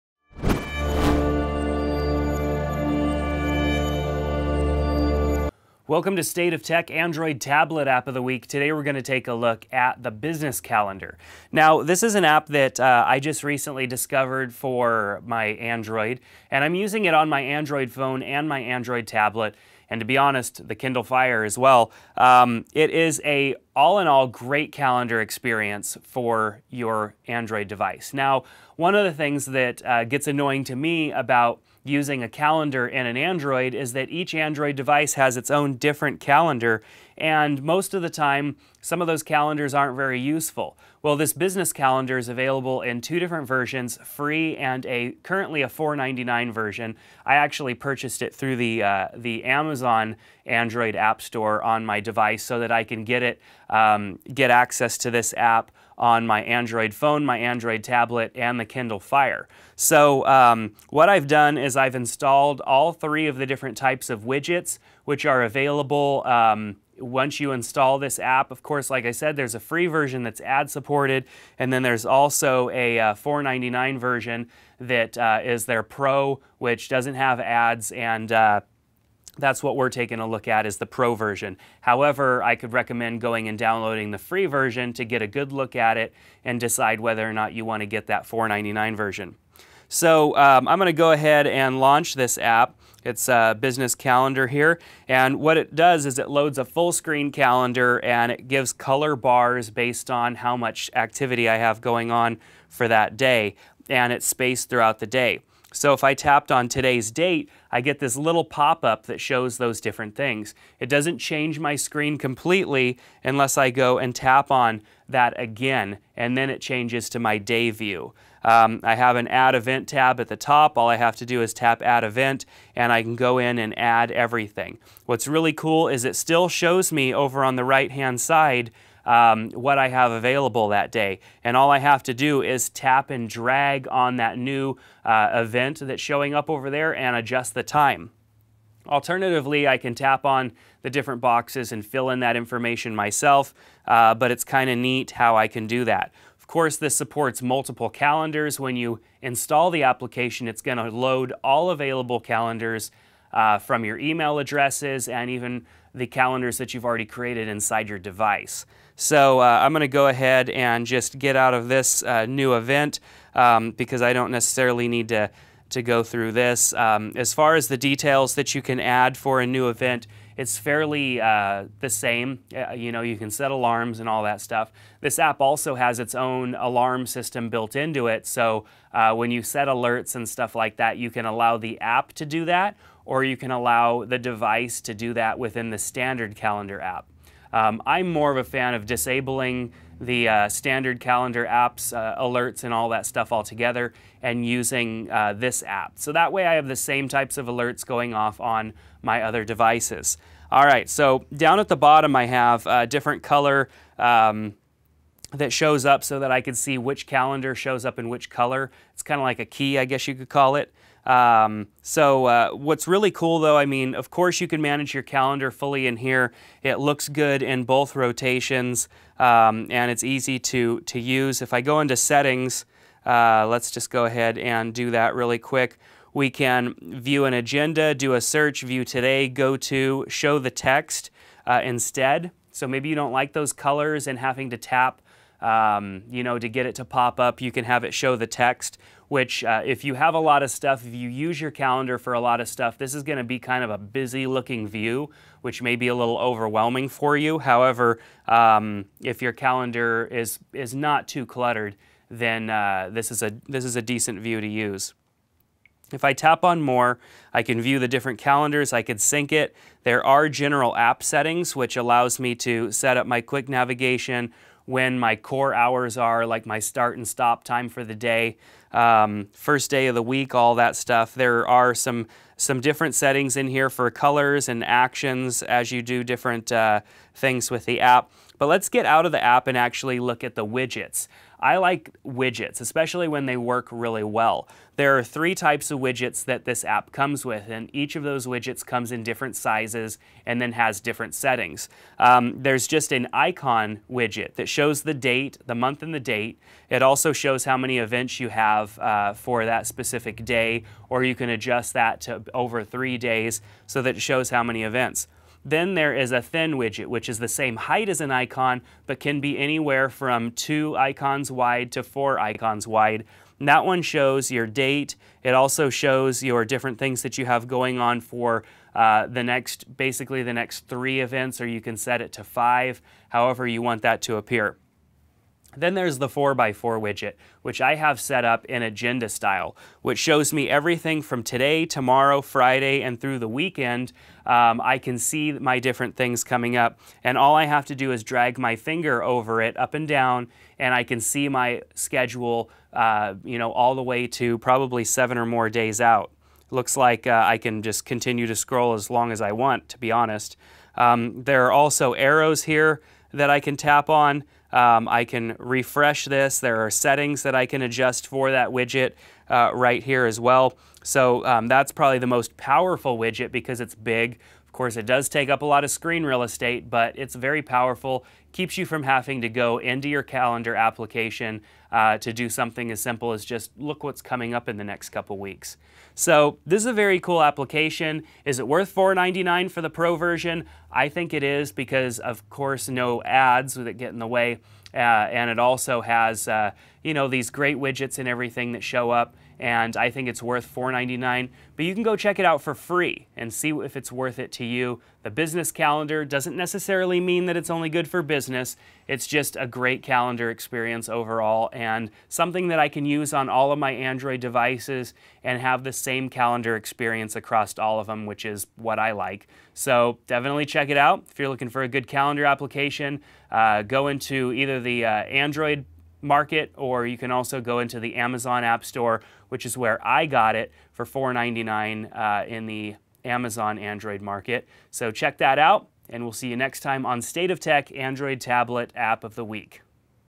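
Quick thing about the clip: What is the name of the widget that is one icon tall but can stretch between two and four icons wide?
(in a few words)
thin widget.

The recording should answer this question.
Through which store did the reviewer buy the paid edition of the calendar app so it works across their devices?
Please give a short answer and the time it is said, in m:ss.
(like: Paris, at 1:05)
Amazon Android App Store, at 0:49.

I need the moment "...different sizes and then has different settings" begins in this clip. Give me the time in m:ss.
4:49.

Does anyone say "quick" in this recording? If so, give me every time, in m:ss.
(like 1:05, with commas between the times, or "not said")
3:45, 4:23.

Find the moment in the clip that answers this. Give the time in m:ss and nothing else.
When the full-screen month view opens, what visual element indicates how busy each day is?
1:38.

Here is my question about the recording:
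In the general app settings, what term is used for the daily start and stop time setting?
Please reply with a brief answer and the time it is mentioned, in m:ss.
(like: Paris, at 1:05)
core hours, at 4:25.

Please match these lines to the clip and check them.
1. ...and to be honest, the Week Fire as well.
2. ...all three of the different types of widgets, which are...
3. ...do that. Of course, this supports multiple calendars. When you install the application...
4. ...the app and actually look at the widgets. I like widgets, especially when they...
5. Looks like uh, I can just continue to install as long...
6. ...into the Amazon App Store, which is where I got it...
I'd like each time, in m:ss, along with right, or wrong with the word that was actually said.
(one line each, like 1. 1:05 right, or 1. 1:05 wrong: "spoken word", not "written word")
1. 0:19 wrong: "Kindle", not "Week"
2. 1:02 right
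3. 2:25 right
4. 4:39 right
5. 5:46 wrong: "scroll", not "install"
6. 6:57 right.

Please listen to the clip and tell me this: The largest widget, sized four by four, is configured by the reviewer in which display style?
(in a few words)
agenda style.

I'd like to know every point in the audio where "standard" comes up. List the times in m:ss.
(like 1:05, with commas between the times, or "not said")
3:05, 3:10.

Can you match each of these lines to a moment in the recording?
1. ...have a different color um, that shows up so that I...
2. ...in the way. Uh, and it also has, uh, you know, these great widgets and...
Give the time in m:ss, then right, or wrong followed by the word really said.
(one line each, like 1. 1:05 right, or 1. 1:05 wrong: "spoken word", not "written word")
1. 3:22 right
2. 6:23 right.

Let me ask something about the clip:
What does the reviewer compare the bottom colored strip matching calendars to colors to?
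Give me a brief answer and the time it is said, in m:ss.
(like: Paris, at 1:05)
a key, at 3:29.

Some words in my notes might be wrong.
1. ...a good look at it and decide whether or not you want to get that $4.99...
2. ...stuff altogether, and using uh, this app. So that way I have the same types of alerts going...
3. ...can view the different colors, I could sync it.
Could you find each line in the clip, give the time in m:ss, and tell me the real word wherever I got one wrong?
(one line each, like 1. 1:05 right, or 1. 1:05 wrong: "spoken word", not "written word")
1. 1:25 right
2. 3:13 right
3. 4:17 wrong: "calendars", not "colors".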